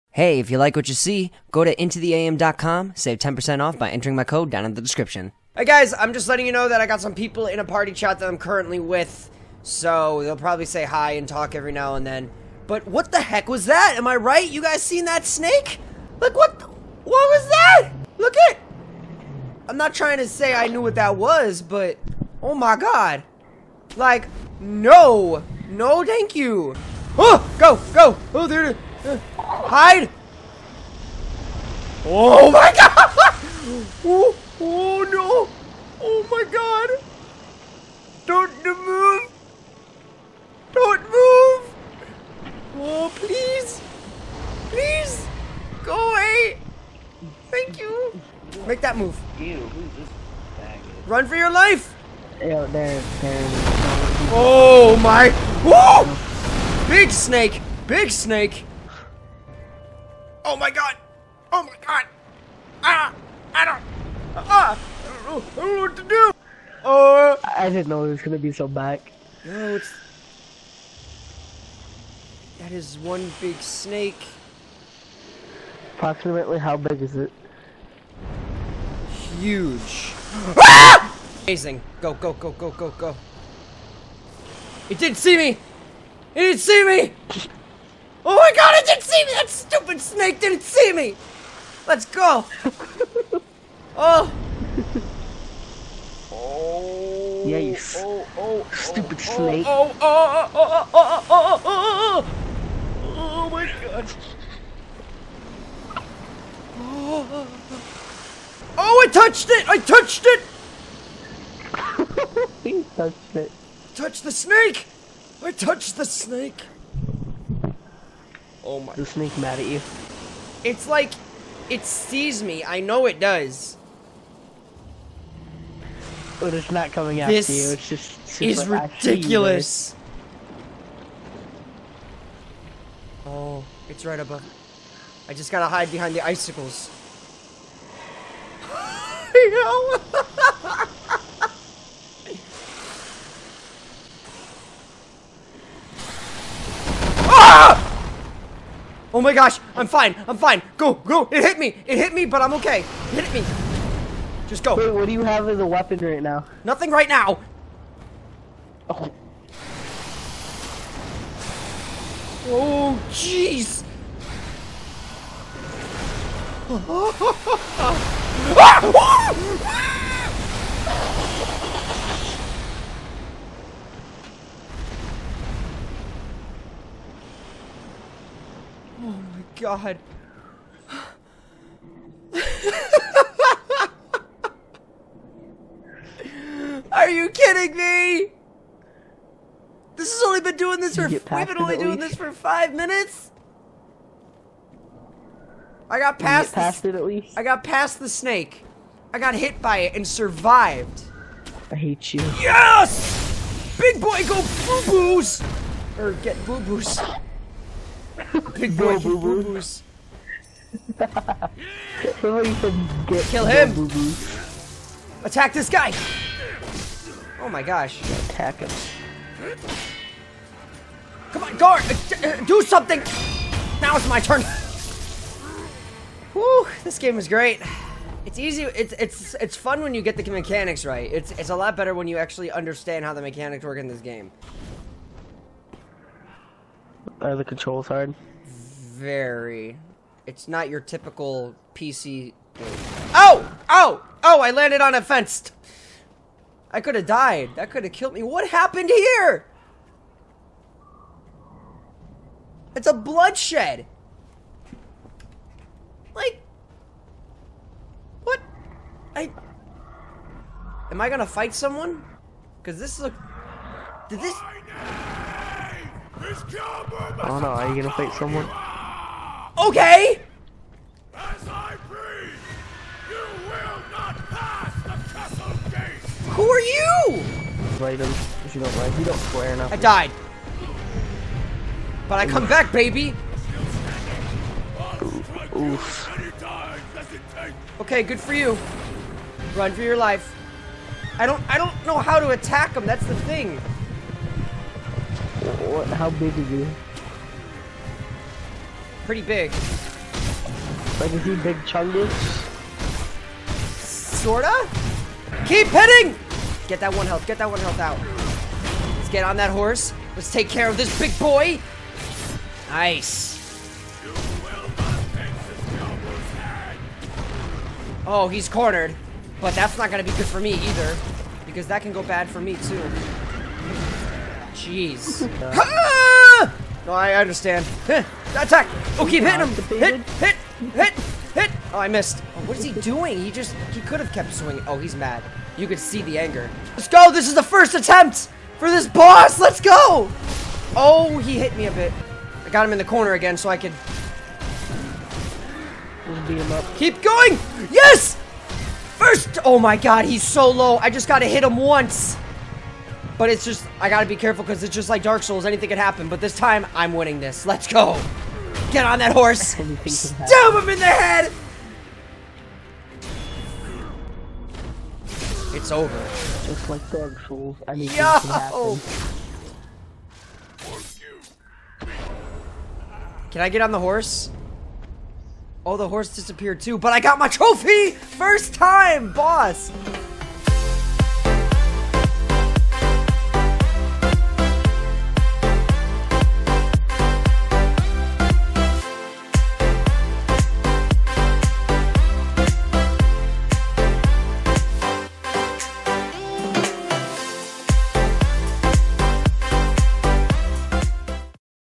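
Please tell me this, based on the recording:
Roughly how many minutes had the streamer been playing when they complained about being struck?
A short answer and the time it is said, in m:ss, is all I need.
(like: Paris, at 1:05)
5, at 3:12.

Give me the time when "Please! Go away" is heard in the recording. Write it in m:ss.
0:44.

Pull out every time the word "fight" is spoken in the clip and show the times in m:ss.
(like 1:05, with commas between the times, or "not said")
4:21, 4:27.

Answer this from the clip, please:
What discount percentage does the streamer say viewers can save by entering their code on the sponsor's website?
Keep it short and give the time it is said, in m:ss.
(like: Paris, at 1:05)
10%, at 0:03.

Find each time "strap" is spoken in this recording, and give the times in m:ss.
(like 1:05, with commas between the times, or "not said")
not said.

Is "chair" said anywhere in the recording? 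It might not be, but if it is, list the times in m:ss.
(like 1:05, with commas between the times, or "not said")
not said.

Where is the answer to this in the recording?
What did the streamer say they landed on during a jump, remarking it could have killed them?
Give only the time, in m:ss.
4:04.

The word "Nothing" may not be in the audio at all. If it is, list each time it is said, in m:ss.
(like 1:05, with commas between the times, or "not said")
2:36.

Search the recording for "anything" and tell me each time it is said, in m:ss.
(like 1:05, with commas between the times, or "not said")
5:55, 6:07.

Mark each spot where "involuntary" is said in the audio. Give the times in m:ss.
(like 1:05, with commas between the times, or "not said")
not said.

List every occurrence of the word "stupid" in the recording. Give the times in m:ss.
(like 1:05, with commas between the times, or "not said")
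1:29, 1:38.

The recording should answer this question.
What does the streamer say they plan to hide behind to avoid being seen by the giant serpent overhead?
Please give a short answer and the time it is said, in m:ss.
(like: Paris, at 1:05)
The icicles, at 2:16.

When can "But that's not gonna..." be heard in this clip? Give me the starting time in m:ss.
5:19.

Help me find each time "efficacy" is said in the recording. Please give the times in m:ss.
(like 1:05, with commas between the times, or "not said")
not said.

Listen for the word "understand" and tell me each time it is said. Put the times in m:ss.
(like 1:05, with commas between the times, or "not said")
3:52, 5:27.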